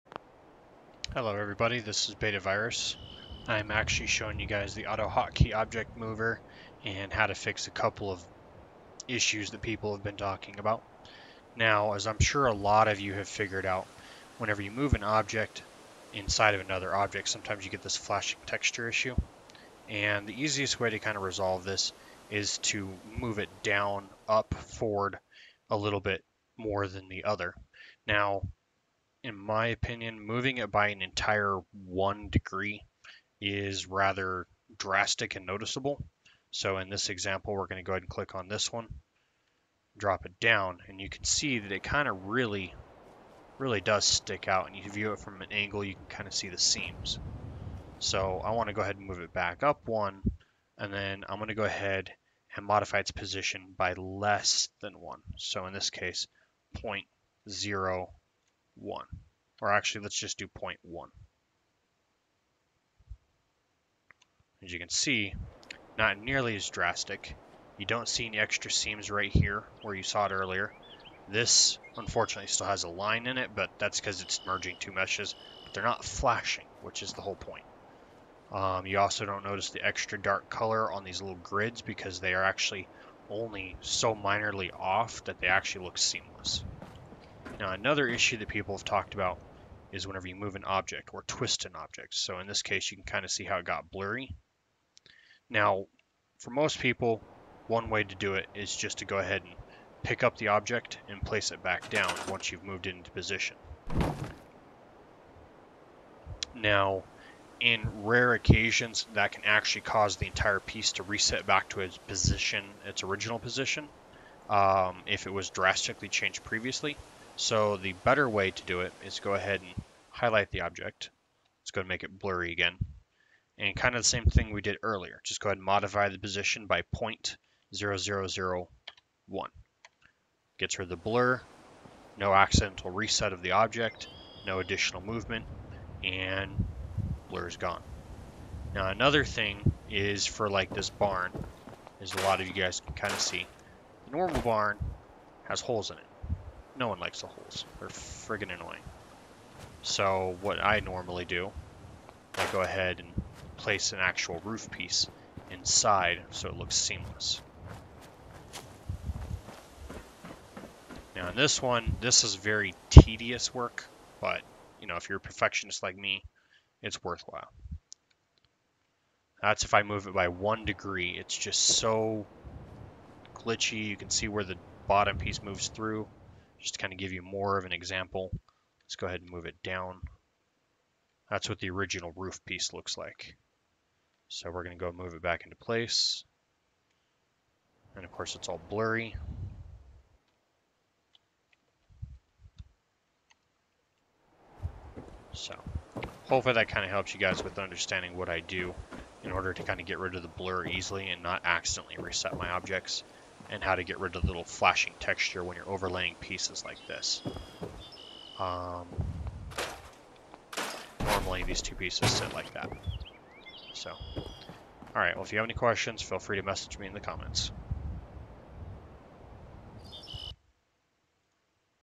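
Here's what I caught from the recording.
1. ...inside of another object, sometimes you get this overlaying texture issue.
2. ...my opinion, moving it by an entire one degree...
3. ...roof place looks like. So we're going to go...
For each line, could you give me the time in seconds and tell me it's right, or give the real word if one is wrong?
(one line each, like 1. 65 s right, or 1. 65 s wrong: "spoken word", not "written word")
1. 16 s wrong: "flashing", not "overlaying"
2. 29 s right
3. 182 s wrong: "piece", not "place".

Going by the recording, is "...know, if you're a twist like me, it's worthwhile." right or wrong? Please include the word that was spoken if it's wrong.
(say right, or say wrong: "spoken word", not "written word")
wrong: "perfectionist", not "twist".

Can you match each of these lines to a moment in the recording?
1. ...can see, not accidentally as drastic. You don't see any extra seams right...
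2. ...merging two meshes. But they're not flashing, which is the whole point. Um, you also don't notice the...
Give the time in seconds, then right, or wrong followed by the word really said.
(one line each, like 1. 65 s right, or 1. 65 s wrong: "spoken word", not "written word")
1. 64 s wrong: "nearly", not "accidentally"
2. 74 s right.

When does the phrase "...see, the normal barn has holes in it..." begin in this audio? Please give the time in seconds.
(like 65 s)
143 s.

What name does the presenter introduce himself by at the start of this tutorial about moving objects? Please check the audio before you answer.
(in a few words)
Beta Virus.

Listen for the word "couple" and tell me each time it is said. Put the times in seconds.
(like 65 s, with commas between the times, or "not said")
7 s.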